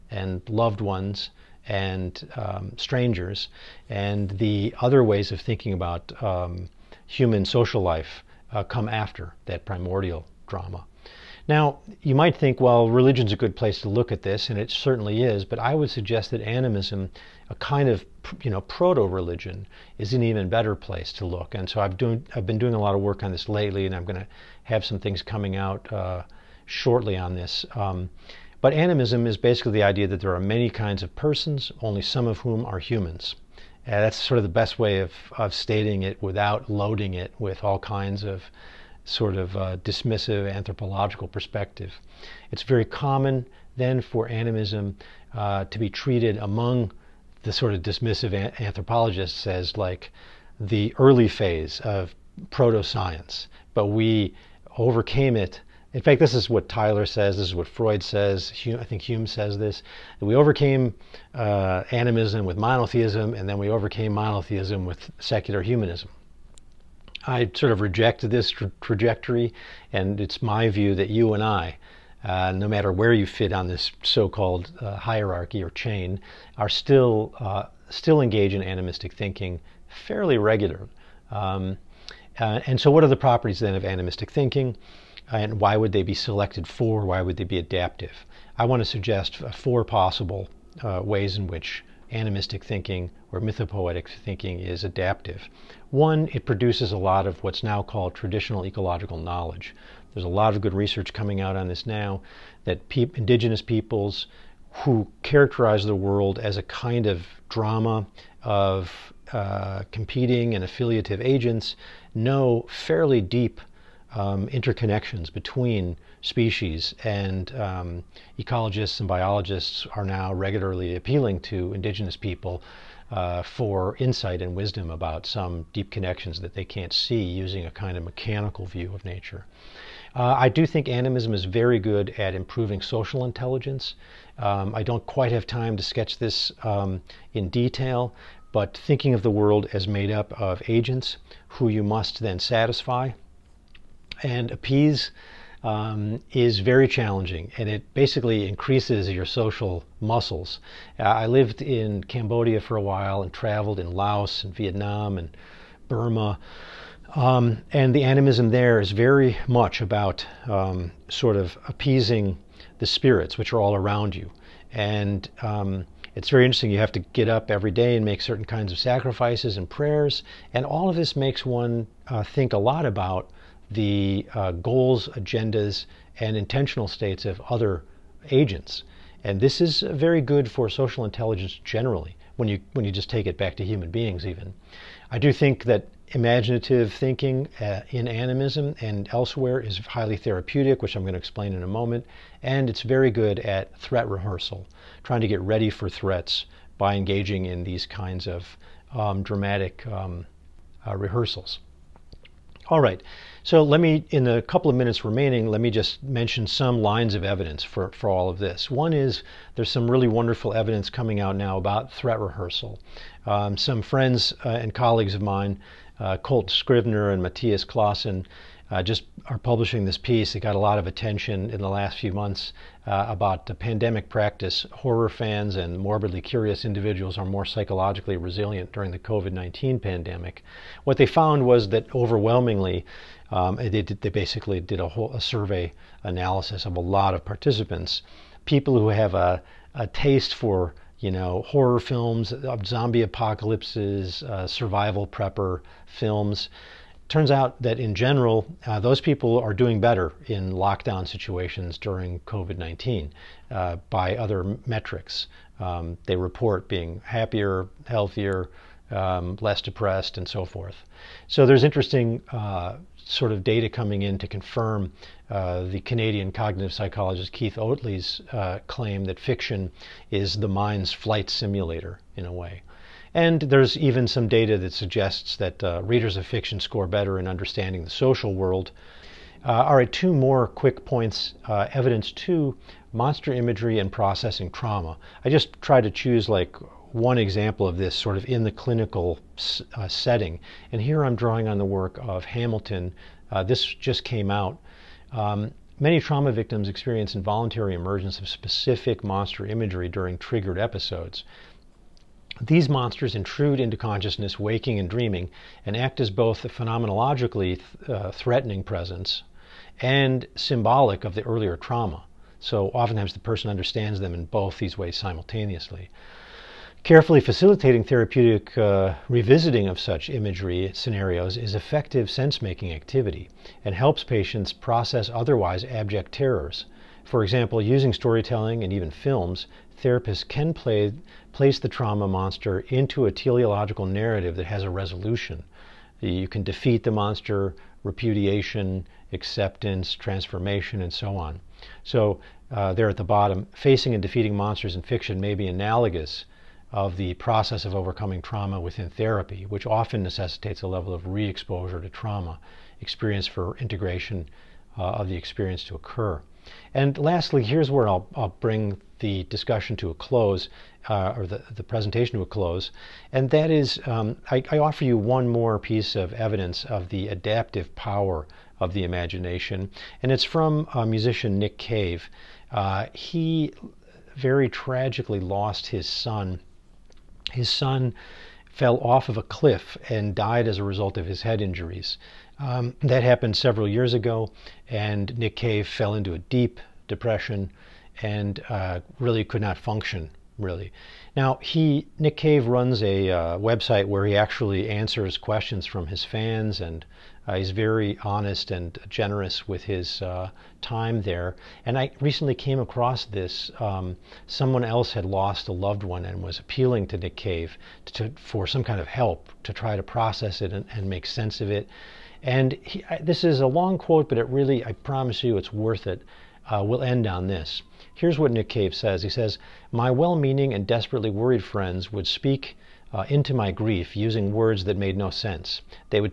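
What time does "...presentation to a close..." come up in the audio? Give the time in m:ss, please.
6:01.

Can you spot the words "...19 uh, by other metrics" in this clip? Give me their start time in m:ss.
4:12.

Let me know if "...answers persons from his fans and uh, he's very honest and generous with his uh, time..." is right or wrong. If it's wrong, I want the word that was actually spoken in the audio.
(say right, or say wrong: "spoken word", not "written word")
wrong: "questions", not "persons".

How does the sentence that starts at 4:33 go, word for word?
And there's even some data that suggests that uh, readers of fiction score better in understanding the social world.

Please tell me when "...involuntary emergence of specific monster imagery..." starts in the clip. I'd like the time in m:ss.
4:57.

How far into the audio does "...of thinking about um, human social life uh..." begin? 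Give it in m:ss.
0:05.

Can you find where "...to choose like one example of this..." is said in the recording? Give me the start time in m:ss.
4:45.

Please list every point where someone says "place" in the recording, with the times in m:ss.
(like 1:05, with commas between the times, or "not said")
0:13, 0:20, 5:31.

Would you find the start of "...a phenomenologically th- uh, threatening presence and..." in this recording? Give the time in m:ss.
5:06.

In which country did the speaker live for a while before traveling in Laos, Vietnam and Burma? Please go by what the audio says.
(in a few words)
Cambodia.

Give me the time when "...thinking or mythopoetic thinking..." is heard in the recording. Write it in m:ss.
1:32.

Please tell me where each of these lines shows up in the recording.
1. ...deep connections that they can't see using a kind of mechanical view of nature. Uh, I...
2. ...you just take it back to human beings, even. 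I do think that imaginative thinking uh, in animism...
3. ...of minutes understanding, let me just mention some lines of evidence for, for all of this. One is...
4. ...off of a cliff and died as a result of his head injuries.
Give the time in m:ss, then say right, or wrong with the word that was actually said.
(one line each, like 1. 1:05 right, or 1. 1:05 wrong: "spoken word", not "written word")
1. 2:05 right
2. 3:02 right
3. 3:24 wrong: "remaining", not "understanding"
4. 6:18 right.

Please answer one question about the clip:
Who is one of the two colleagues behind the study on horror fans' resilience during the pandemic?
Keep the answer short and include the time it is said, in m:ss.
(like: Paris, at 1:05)
Mathias Clasen, at 3:37.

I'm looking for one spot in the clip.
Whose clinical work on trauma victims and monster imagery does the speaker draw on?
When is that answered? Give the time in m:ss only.
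4:52.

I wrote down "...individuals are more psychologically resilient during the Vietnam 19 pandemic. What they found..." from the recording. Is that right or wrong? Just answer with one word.
wrong.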